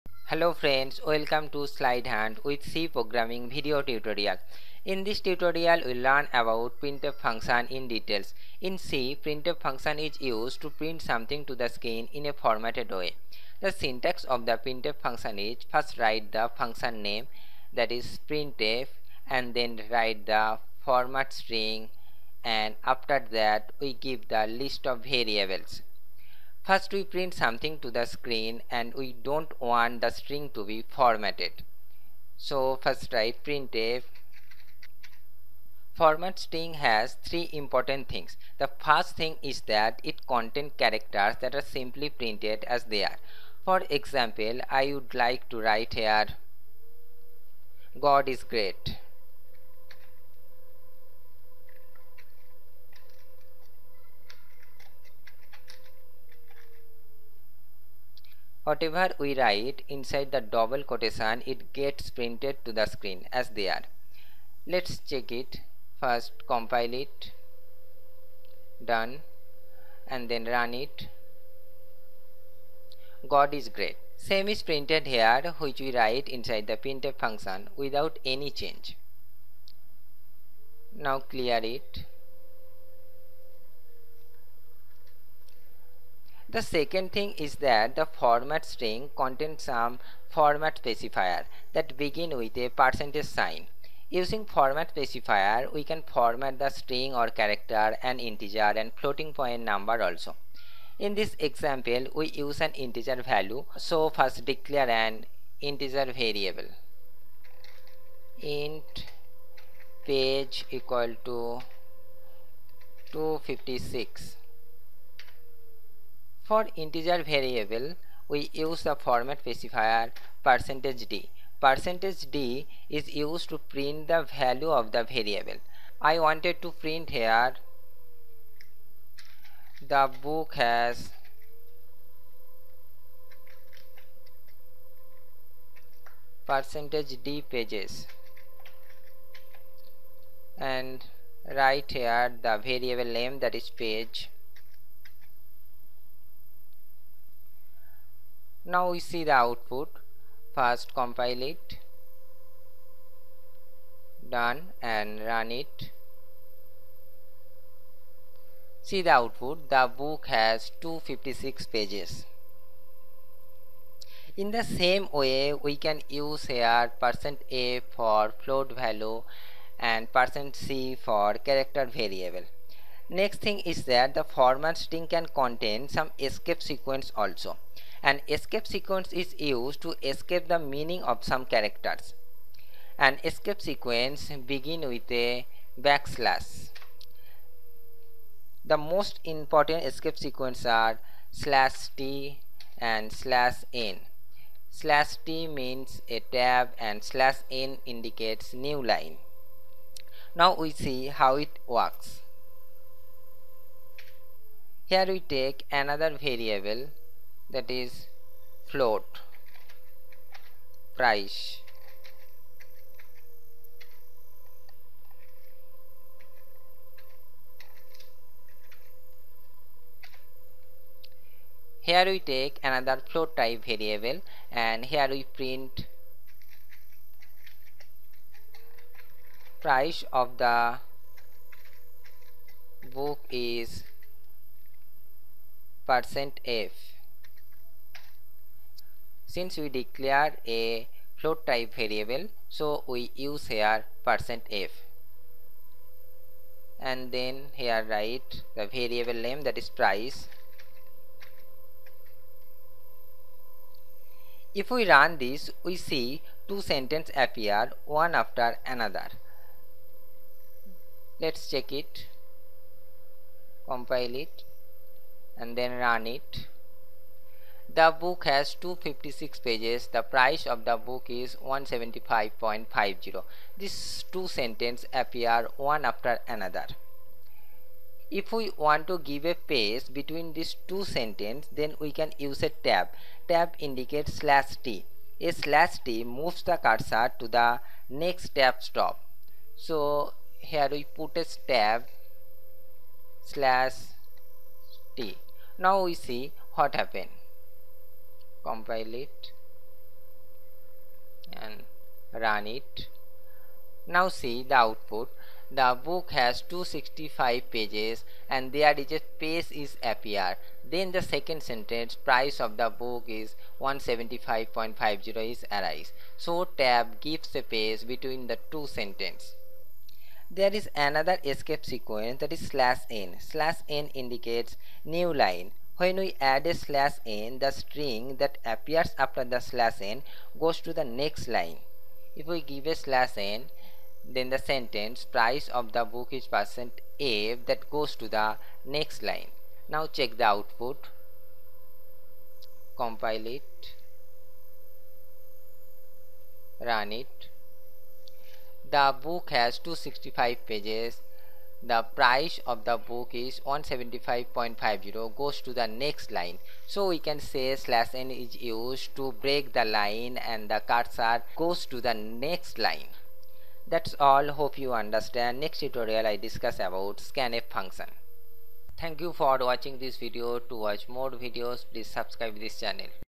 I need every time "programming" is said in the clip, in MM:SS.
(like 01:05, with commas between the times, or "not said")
00:02.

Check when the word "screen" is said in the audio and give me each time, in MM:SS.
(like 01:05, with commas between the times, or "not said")
00:11, 00:28, 01:02.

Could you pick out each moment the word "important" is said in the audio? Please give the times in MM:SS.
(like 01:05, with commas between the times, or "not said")
00:37, 03:09.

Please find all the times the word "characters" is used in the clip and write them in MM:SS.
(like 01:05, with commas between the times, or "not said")
00:40, 01:37, 02:51, 03:01.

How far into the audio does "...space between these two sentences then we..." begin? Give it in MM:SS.
04:39.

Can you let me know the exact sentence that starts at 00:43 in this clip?
For example, I would like to write here God is great.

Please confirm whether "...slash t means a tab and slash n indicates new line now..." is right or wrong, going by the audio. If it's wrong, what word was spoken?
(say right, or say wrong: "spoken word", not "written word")
right.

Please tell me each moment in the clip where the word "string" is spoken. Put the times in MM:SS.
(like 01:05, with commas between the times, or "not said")
00:21, 00:30, 00:36, 01:28, 01:36, 02:54, 05:27.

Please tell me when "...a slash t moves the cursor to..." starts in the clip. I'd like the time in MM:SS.
04:45.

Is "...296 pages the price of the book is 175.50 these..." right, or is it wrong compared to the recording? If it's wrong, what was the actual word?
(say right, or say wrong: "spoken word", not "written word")
wrong: "256", not "296".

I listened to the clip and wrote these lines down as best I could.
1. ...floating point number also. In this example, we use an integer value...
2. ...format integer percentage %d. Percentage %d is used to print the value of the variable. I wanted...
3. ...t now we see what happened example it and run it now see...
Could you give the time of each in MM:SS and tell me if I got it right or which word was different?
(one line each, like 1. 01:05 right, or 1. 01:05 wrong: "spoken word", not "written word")
1. 01:38 right
2. 01:58 wrong: "specifier", not "integer"
3. 04:54 wrong: "compile", not "example".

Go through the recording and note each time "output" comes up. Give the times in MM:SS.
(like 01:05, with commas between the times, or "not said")
02:29, 02:39, 05:04, 05:40.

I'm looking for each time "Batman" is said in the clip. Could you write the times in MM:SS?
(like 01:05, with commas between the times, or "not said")
not said.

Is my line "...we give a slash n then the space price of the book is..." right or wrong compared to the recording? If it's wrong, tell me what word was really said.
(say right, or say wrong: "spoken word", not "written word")
wrong: "sentence", not "space".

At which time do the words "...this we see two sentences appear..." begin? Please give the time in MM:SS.
04:15.